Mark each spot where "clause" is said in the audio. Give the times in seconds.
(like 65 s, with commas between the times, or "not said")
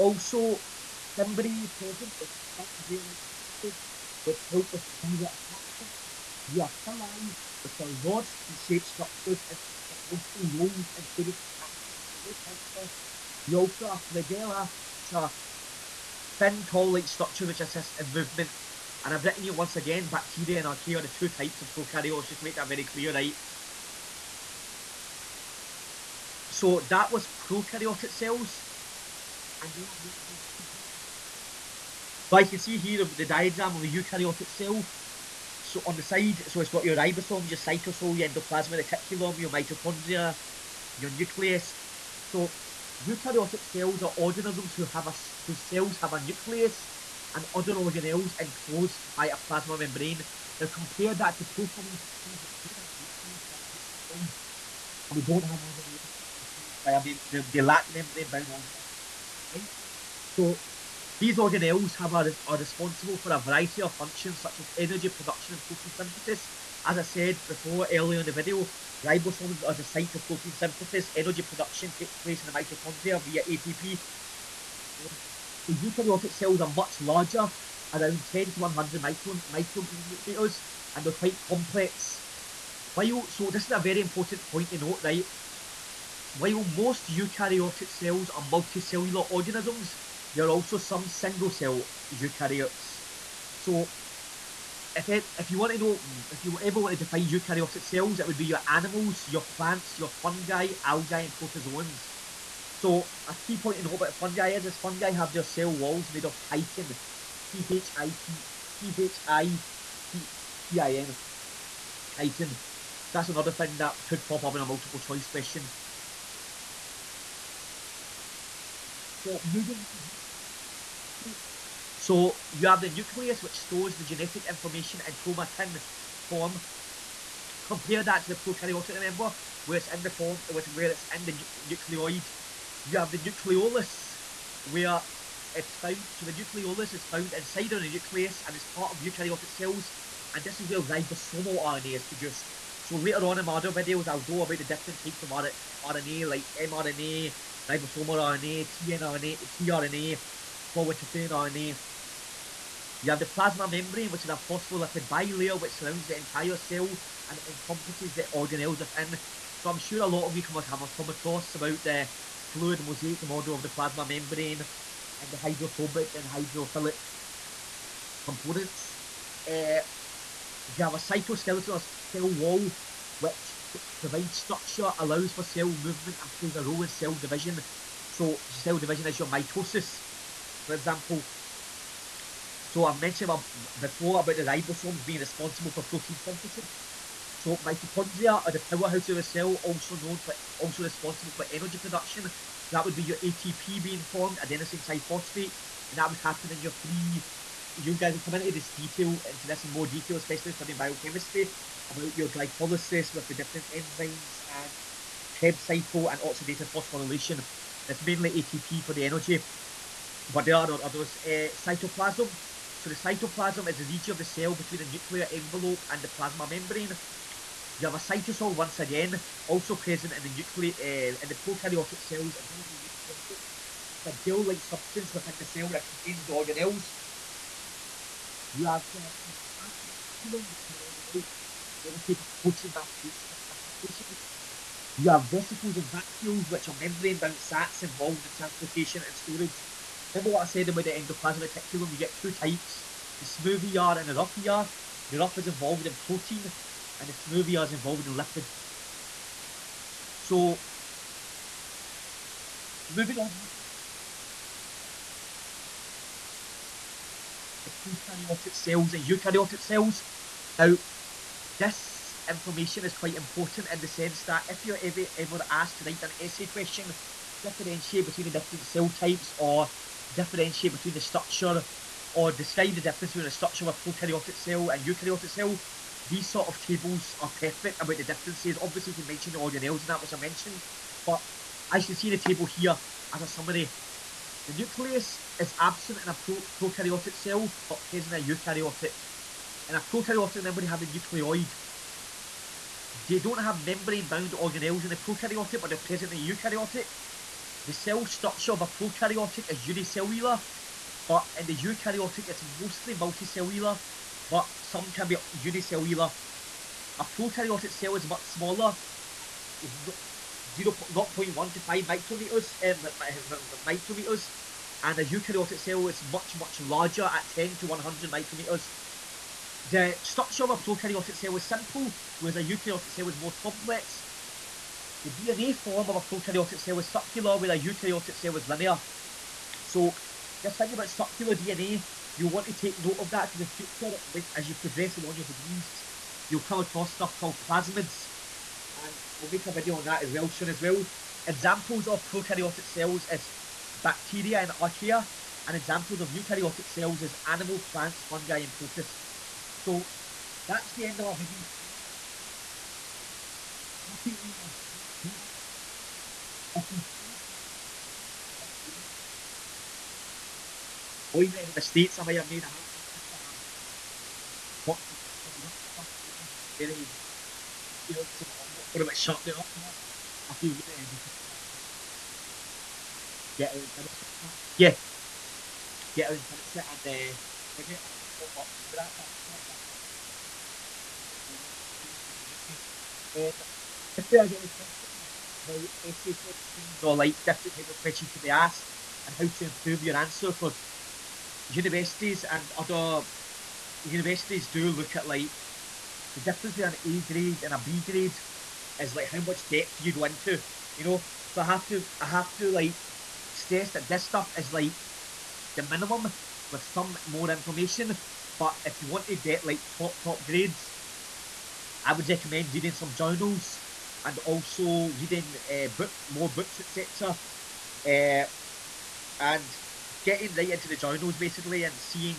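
not said.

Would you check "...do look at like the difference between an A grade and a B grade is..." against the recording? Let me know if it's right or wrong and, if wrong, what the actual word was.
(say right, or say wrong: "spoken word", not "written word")
right.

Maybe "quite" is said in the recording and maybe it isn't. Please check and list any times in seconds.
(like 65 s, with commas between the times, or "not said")
81 s, 262 s.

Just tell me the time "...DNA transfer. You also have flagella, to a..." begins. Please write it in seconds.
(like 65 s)
11 s.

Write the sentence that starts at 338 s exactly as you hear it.
And I'll make a video on that as well soon as well.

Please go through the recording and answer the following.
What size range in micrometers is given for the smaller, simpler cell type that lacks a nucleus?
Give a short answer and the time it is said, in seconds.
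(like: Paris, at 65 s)
0.1 to 5 micrometers, at 310 s.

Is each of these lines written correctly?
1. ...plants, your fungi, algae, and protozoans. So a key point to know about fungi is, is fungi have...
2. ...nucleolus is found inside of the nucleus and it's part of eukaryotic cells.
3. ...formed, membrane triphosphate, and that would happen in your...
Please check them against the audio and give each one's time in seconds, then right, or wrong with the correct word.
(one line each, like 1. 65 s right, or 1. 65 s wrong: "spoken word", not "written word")
1. 99 s right
2. 136 s right
3. 194 s wrong: "adenosine", not "membrane".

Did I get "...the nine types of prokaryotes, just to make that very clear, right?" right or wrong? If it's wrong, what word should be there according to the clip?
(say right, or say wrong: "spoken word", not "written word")
wrong: "two", not "nine".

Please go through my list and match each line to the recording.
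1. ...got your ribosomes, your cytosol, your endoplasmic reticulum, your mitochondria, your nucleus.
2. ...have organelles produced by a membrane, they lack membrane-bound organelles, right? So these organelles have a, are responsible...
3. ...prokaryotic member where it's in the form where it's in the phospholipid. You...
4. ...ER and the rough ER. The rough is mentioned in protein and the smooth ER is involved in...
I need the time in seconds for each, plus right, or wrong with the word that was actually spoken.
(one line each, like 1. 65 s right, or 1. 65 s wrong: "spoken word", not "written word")
1. 36 s right
2. 55 s wrong: "enclosed", not "produced"
3. 128 s wrong: "nucleoid", not "phospholipid"
4. 243 s wrong: "involved", not "mentioned".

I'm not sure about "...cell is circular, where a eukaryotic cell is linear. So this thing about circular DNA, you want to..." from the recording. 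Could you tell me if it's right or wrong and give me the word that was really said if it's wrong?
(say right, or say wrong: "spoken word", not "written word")
right.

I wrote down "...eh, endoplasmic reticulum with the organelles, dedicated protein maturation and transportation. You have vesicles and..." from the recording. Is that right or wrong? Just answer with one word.
right.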